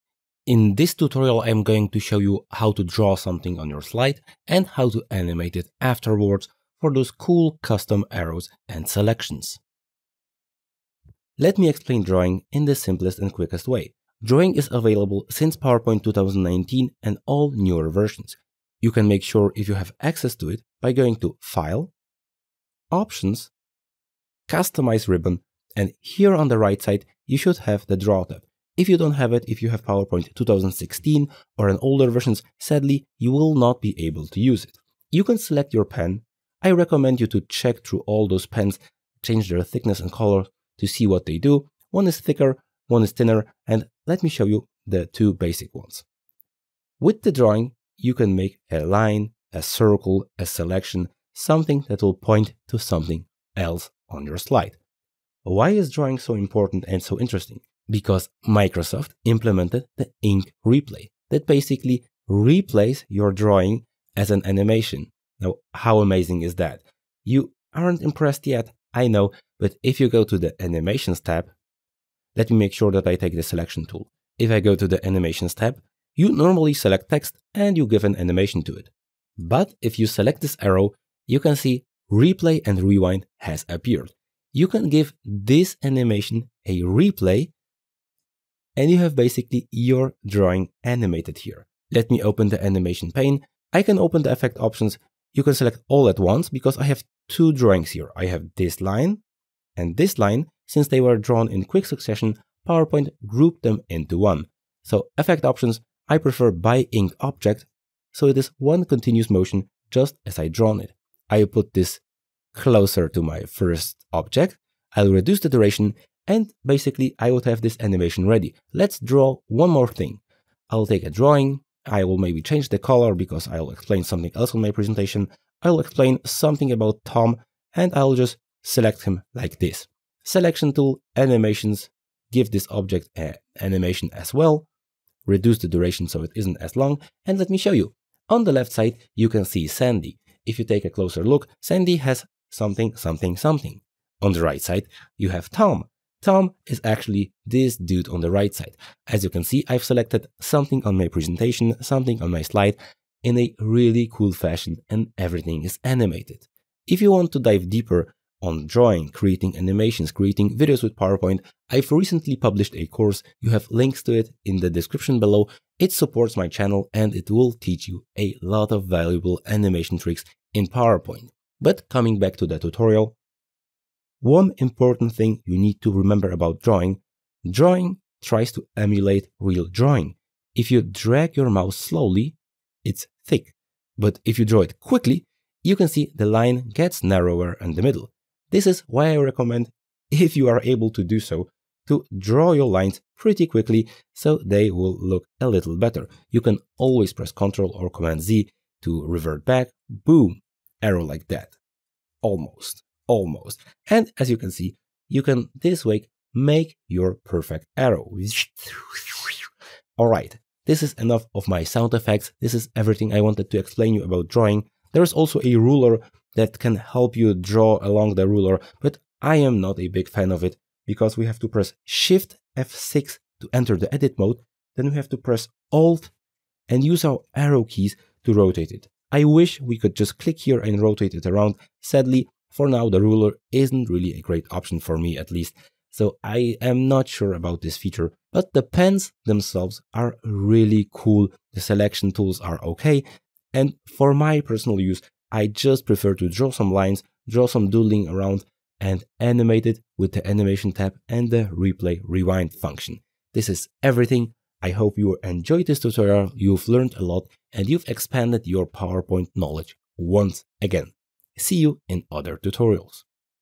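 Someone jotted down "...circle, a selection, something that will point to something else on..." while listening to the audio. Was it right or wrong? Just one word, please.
right.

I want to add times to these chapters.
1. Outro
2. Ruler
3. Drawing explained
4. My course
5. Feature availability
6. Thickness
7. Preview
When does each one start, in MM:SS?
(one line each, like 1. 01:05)
1. 03:58
2. 03:34
3. 00:34
4. 02:36
5. 00:11
6. 02:51
7. 02:16.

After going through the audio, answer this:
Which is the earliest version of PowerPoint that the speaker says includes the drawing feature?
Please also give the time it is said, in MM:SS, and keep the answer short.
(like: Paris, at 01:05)
PowerPoint 2019, at 00:15.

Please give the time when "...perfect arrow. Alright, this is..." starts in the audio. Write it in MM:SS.
03:27.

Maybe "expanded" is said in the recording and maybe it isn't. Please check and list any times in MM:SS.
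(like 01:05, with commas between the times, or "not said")
04:17.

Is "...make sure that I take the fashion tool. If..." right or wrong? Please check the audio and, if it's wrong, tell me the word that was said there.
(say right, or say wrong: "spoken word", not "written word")
wrong: "selection", not "fashion".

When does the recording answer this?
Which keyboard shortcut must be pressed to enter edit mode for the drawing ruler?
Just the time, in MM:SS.
03:41.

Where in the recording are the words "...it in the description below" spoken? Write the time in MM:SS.
02:44.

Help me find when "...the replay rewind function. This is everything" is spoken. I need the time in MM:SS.
04:11.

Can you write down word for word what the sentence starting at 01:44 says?
So effect options, I prefer by ink object, so it is one continuous motion just as I drawn it.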